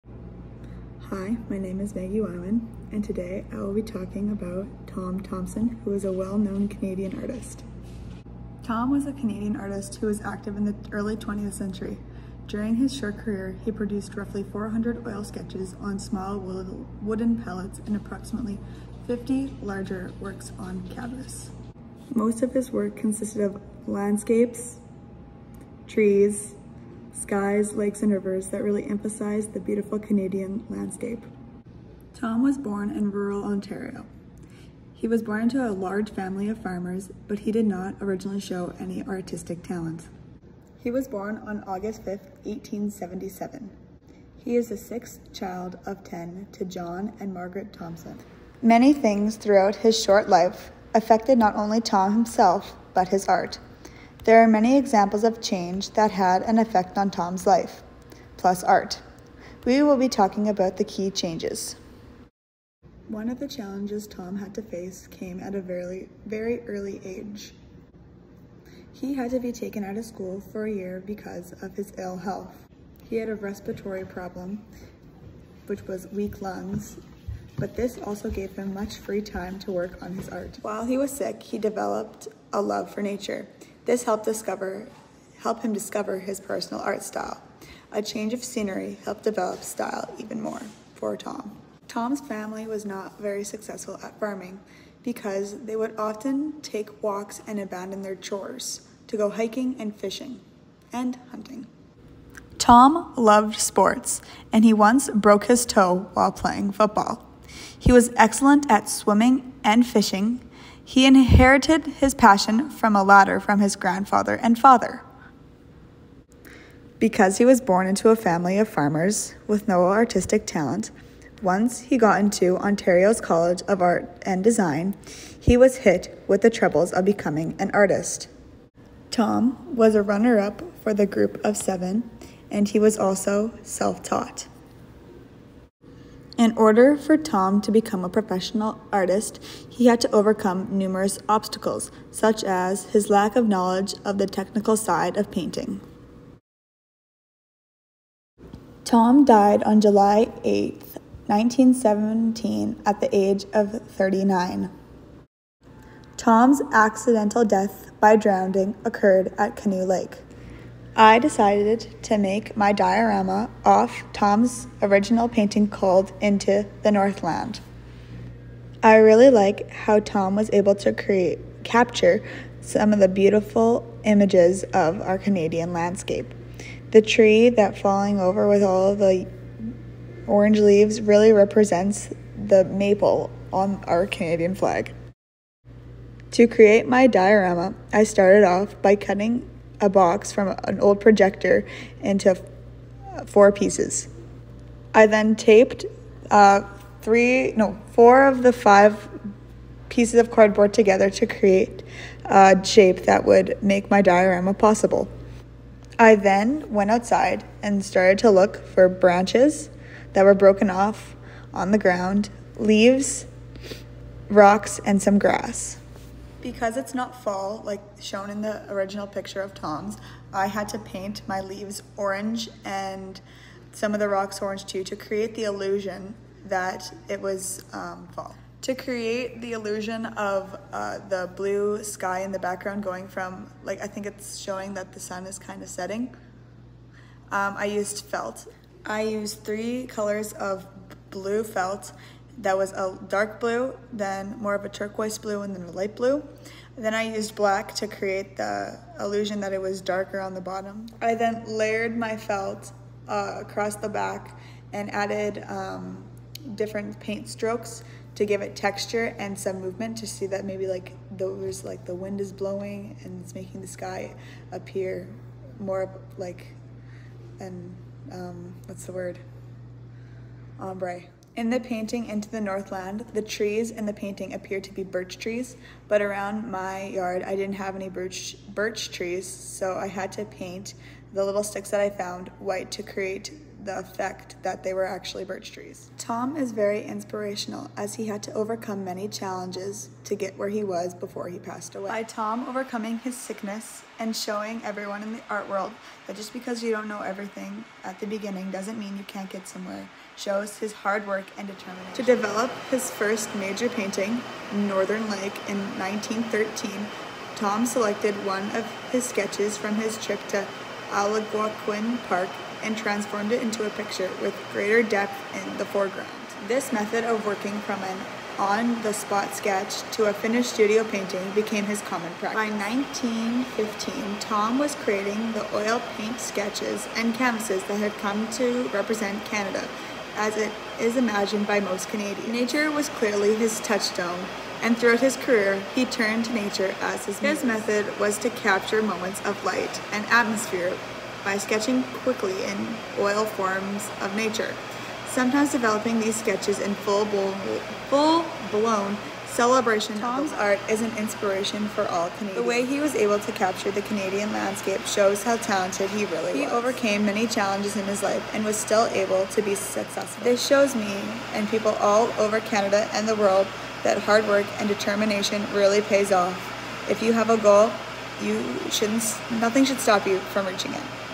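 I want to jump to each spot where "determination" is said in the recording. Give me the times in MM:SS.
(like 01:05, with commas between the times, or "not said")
05:01, 06:04.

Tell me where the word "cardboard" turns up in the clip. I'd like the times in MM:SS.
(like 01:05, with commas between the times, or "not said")
03:20.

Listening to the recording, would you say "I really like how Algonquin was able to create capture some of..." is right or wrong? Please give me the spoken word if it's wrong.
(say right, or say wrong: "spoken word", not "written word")
wrong: "Tom", not "Algonquin".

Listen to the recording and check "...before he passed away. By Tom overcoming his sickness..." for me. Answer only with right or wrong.
right.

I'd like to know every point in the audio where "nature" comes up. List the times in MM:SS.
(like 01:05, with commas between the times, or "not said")
01:23, 05:32, 05:36, 05:44.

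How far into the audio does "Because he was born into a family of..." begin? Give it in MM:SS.
01:56.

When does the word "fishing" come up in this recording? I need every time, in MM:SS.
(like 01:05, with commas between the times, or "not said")
01:39, 01:49.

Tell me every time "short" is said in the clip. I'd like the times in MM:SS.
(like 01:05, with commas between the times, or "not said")
00:12, 00:50.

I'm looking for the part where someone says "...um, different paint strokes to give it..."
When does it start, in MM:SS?
04:15.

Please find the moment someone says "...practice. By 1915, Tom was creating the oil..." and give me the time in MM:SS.
05:22.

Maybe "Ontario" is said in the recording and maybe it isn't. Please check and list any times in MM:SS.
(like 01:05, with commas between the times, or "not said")
00:33, 02:02.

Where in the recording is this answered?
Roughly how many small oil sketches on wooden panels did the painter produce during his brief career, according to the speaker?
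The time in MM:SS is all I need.
00:14.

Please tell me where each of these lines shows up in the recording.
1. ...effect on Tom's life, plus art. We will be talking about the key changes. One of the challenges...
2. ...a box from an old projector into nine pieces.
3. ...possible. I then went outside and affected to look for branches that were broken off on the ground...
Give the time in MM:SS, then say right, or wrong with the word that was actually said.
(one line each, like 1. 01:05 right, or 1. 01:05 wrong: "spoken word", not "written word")
1. 00:56 right
2. 03:09 wrong: "four", not "nine"
3. 03:24 wrong: "started", not "affected".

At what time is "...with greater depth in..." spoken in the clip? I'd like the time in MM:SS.
05:14.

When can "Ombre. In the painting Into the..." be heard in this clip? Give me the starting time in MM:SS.
04:30.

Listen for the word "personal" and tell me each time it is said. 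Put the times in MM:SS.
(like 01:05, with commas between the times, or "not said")
01:26.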